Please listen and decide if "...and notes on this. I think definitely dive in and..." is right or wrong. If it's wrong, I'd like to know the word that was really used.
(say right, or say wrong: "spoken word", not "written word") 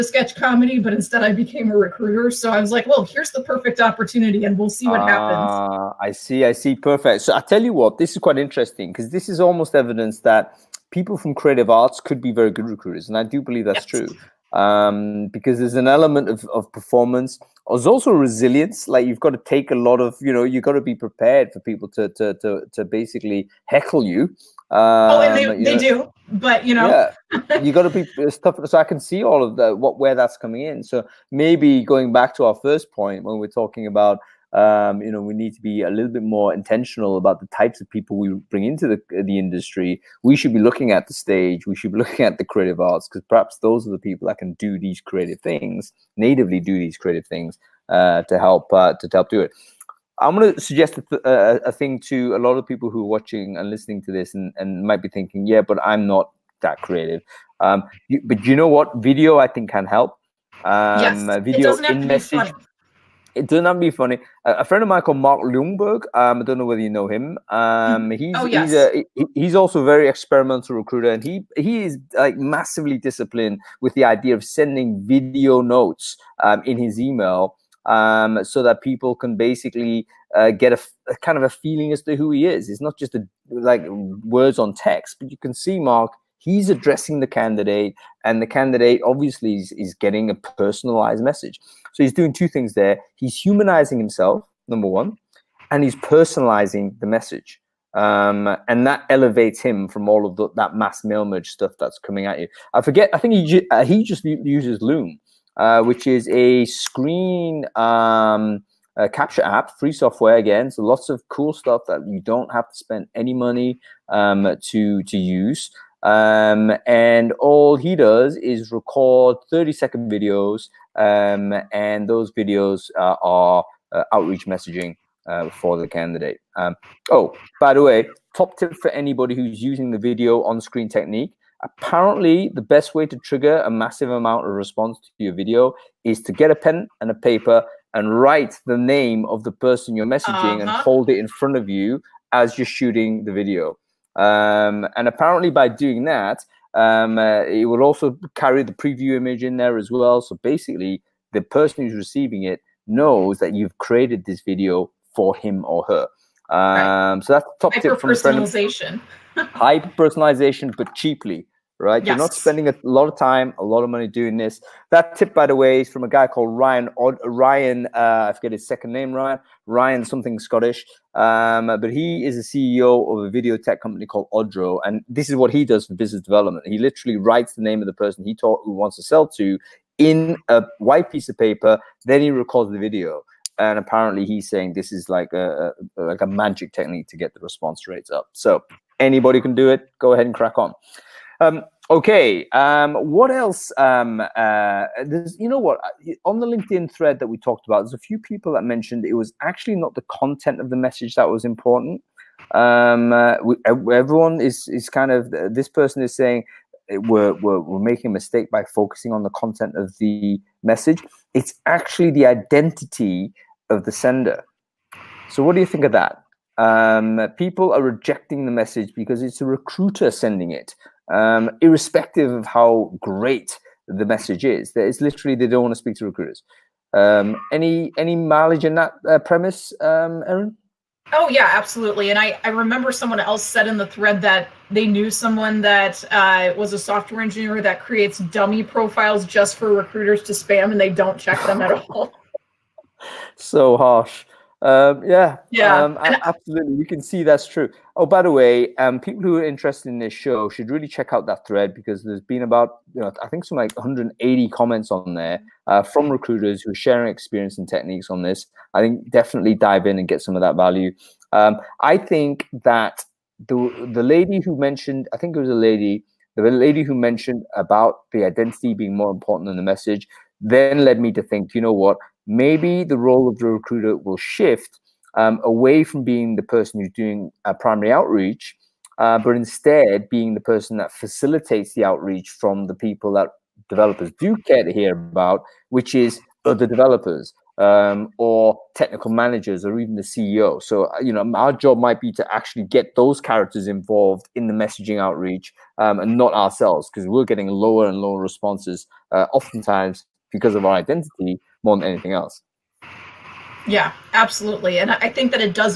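wrong: "techniques", not "notes".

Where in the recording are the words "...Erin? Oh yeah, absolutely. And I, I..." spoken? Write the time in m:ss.
3:50.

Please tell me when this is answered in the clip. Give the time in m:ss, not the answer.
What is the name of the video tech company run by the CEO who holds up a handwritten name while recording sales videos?
2:54.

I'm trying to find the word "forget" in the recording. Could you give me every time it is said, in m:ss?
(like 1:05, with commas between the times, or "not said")
1:42, 2:48.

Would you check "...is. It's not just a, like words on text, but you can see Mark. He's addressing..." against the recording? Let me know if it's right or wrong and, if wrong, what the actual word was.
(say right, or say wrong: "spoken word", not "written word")
right.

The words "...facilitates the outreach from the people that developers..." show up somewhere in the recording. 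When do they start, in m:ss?
4:40.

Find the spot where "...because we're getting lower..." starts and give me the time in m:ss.
4:56.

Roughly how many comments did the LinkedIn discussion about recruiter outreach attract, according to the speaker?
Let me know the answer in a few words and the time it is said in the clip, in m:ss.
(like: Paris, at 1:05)
180, at 4:13.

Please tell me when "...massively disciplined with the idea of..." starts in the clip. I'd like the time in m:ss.
1:12.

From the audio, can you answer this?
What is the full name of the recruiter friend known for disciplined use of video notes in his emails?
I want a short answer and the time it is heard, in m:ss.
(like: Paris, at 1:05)
Mark Ljungberg, at 1:05.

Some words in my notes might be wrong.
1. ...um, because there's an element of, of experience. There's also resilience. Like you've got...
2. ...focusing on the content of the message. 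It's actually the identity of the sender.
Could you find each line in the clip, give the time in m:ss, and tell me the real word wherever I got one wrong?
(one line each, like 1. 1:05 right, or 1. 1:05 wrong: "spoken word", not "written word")
1. 0:14 wrong: "performance", not "experience"
2. 3:28 right.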